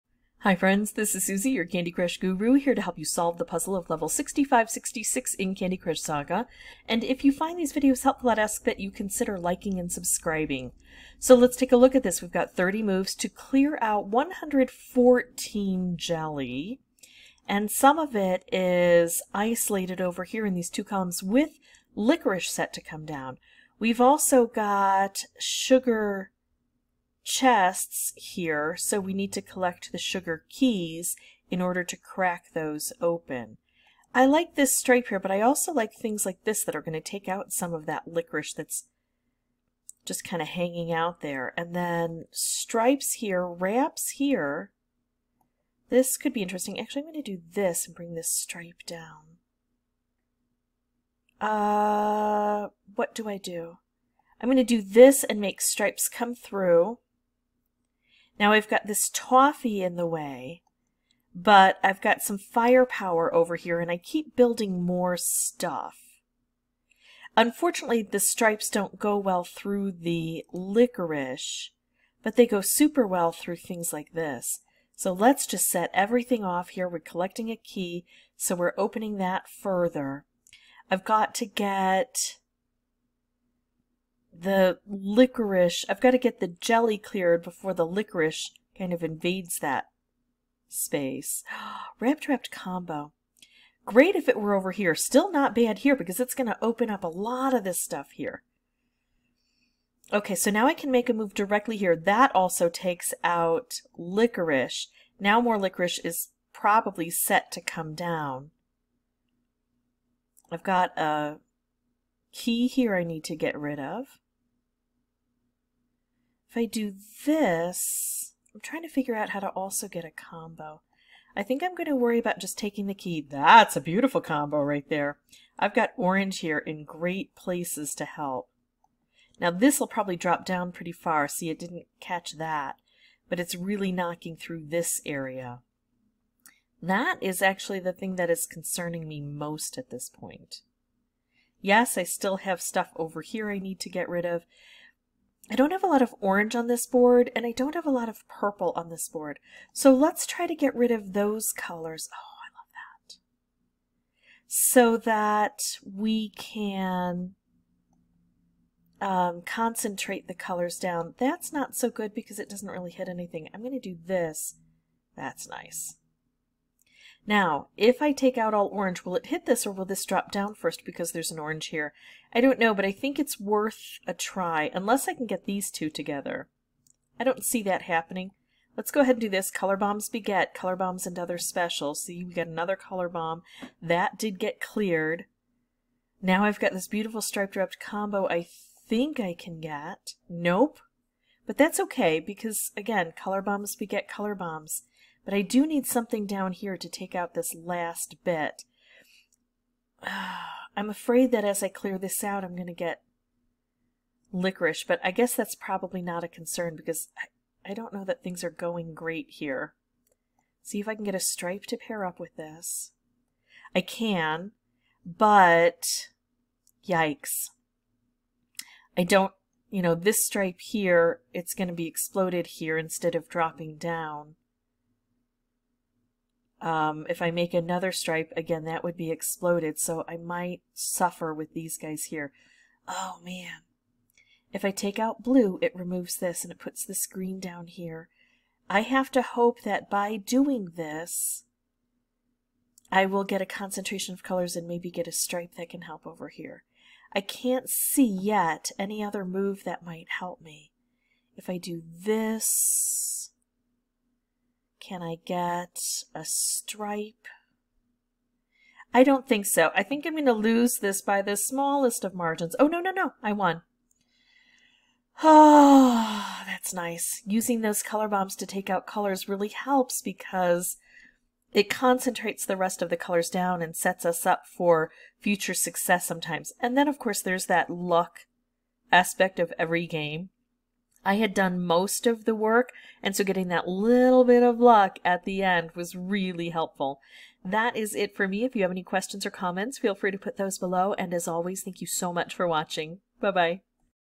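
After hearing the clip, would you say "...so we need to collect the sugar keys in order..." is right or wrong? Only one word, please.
right.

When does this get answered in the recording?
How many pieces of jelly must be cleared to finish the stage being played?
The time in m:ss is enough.
0:14.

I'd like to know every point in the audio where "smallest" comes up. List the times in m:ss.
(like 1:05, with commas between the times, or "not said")
4:21.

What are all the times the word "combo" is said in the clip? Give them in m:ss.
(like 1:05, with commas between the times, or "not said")
1:32, 2:00, 2:04, 3:07.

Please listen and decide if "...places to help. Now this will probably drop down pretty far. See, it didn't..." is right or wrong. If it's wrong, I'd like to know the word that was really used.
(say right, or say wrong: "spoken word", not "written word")
right.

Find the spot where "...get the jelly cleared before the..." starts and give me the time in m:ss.
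1:26.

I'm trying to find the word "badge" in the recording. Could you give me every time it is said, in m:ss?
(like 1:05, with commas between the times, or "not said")
not said.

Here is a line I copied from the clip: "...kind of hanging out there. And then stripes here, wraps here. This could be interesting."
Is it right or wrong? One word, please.
right.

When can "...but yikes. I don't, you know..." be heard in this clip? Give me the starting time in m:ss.
3:35.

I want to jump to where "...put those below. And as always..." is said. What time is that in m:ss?
4:50.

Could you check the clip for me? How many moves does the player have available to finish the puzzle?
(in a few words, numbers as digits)
30.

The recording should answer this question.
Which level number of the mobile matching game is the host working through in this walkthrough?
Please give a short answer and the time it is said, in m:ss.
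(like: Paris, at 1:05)
6566, at 0:03.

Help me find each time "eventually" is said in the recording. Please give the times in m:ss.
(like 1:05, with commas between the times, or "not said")
not said.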